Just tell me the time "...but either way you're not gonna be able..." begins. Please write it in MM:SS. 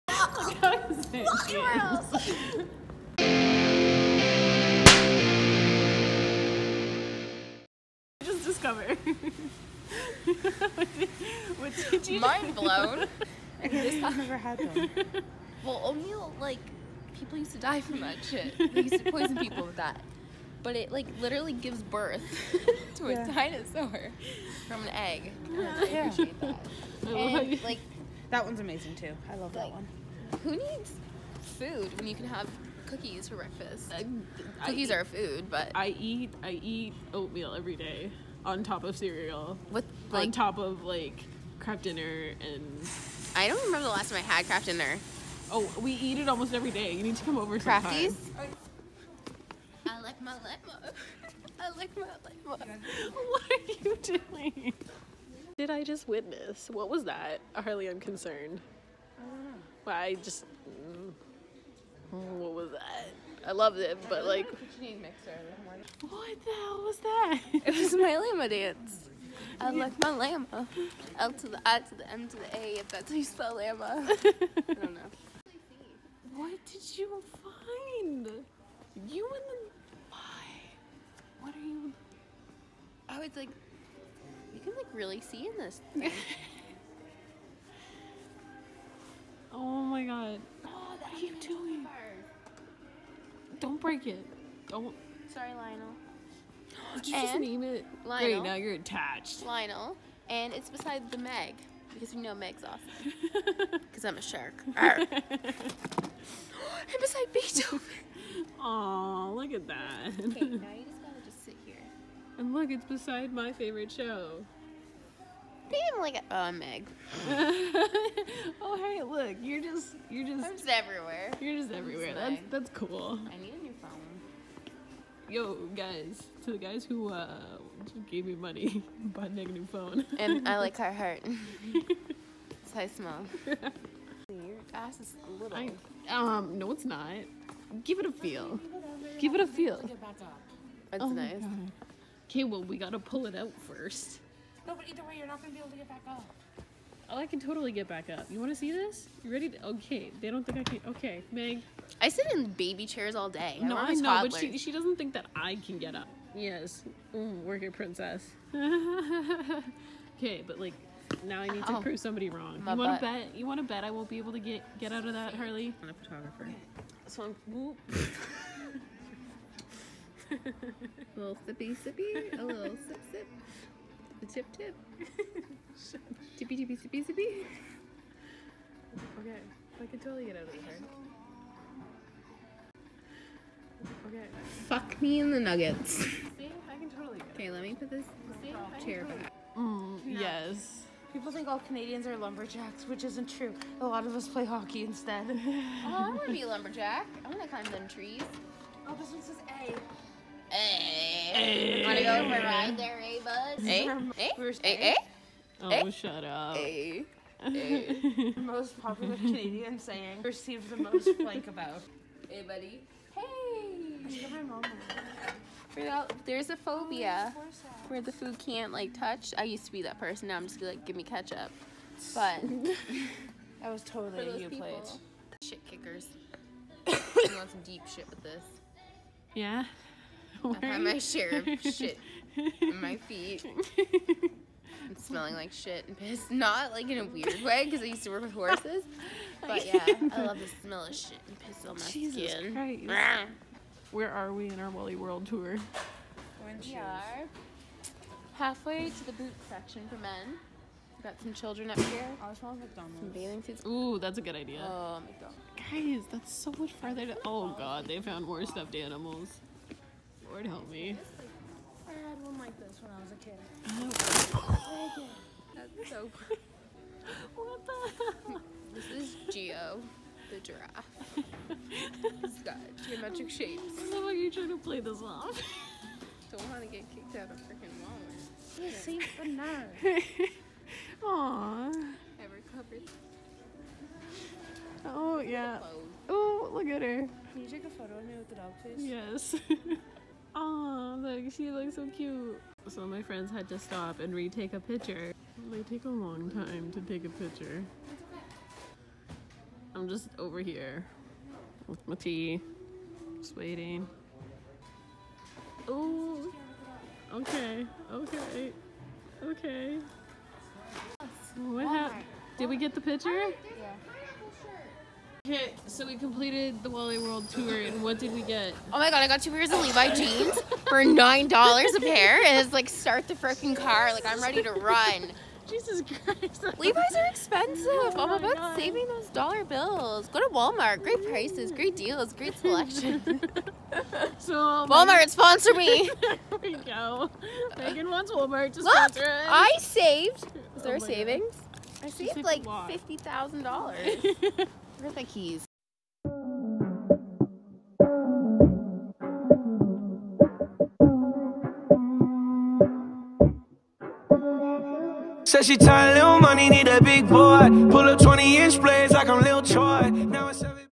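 02:24.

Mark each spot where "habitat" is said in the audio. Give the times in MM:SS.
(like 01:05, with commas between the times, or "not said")
not said.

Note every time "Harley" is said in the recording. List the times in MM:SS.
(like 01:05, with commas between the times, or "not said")
00:57, 02:45.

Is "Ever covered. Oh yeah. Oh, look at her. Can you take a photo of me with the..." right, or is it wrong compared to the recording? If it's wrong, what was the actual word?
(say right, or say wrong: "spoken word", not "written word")
right.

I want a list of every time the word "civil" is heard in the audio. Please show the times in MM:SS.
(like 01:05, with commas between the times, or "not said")
not said.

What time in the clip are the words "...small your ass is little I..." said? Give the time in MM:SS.
02:12.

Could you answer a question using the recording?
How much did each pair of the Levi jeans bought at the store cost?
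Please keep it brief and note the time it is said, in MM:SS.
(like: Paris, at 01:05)
$9, at 05:20.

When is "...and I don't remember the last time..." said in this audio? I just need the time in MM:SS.
00:42.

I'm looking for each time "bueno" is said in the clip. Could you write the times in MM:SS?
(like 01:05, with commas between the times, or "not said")
not said.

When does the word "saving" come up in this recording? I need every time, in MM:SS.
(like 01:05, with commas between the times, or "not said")
05:28, 05:40.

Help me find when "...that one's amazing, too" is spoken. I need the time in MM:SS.
00:28.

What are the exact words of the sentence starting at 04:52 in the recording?
So my friends had to stop and retake a picture.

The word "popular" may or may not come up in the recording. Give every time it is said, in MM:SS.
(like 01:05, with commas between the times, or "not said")
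03:28.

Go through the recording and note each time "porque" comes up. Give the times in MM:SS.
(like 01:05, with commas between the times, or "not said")
not said.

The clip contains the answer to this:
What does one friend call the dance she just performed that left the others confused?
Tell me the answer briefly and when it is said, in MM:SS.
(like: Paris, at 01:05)
llama dance, at 01:08.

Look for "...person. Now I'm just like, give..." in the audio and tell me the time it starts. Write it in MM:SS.
03:39.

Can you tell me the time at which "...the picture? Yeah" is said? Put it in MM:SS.
05:12.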